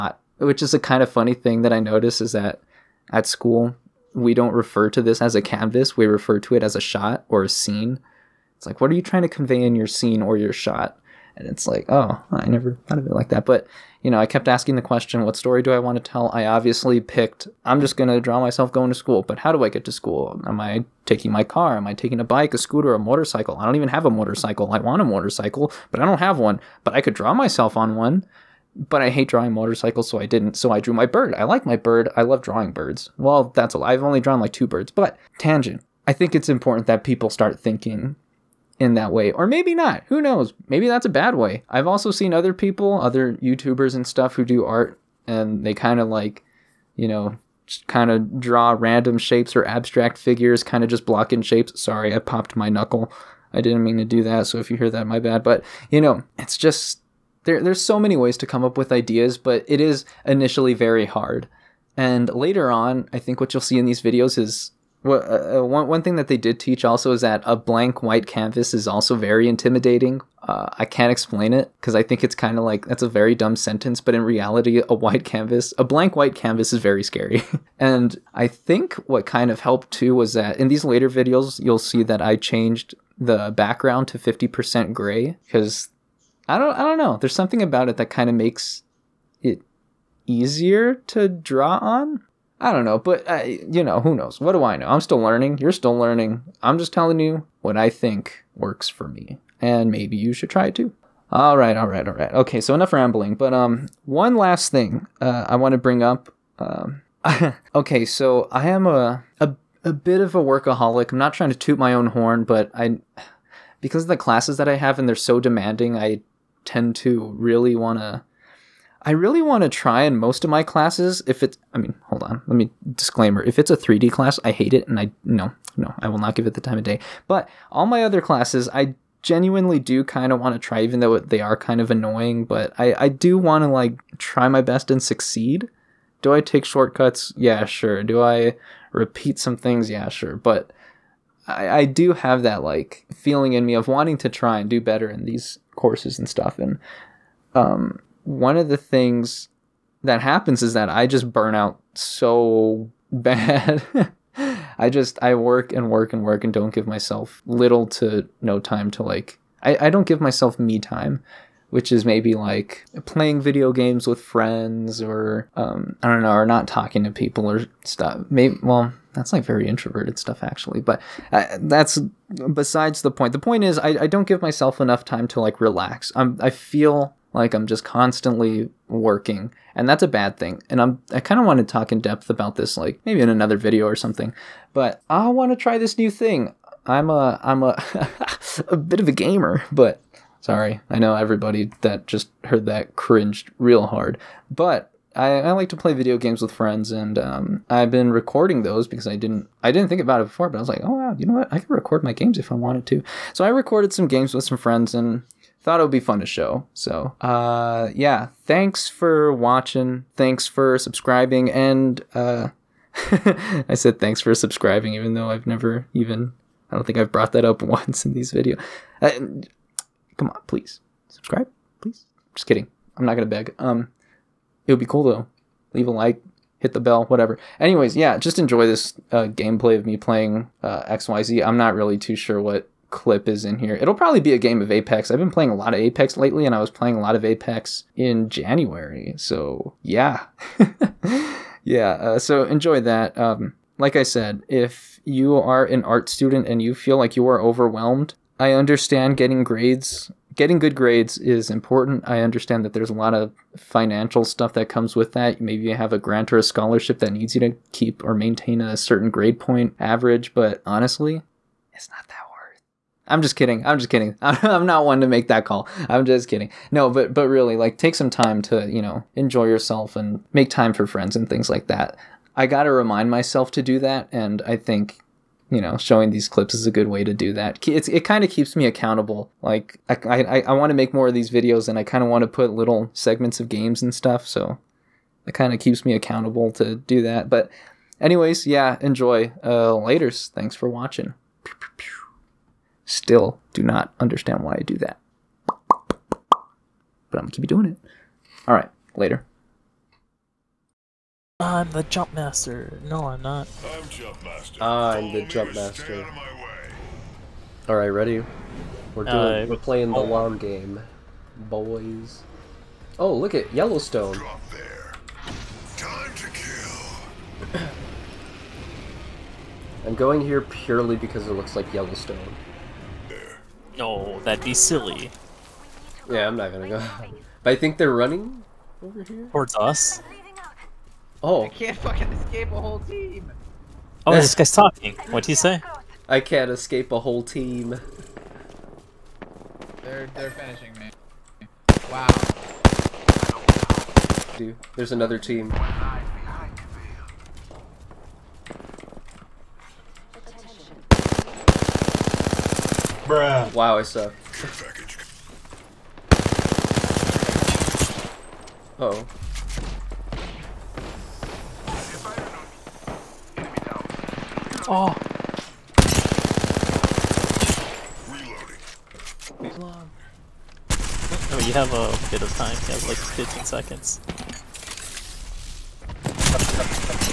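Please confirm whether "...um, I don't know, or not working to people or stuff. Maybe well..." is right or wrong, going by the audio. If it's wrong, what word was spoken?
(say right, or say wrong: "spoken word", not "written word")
wrong: "talking", not "working".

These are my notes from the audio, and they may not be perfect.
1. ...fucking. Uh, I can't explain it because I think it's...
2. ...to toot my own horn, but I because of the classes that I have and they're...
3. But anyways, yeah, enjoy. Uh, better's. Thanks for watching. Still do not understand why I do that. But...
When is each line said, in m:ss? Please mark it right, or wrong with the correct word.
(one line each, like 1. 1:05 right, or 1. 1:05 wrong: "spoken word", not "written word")
1. 1:09 wrong: "intimidating", not "fucking"
2. 1:51 right
3. 4:47 wrong: "later", not "better".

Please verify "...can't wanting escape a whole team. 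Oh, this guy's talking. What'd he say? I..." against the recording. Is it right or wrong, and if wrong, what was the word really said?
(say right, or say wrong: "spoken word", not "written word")
wrong: "fucking", not "wanting".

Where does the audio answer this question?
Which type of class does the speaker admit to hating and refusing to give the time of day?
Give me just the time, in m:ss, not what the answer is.
2:03.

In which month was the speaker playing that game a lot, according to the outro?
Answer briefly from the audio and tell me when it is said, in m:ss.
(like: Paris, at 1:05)
January, at 3:58.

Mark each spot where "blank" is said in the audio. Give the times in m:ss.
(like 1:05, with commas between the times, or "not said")
1:07, 1:15.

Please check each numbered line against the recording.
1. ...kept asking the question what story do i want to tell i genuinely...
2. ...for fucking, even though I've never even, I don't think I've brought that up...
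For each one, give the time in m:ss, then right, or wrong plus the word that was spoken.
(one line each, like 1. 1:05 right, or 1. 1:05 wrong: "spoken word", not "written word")
1. 0:14 wrong: "obviously", not "genuinely"
2. 3:34 wrong: "subscribing", not "fucking".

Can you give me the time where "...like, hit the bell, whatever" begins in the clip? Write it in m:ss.
3:45.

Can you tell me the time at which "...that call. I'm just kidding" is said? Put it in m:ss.
4:25.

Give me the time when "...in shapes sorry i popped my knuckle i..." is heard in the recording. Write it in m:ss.
0:51.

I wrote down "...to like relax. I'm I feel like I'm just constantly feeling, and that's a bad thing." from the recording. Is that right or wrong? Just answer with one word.
wrong.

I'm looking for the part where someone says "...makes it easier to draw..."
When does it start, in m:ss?
1:28.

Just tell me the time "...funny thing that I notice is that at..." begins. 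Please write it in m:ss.
0:01.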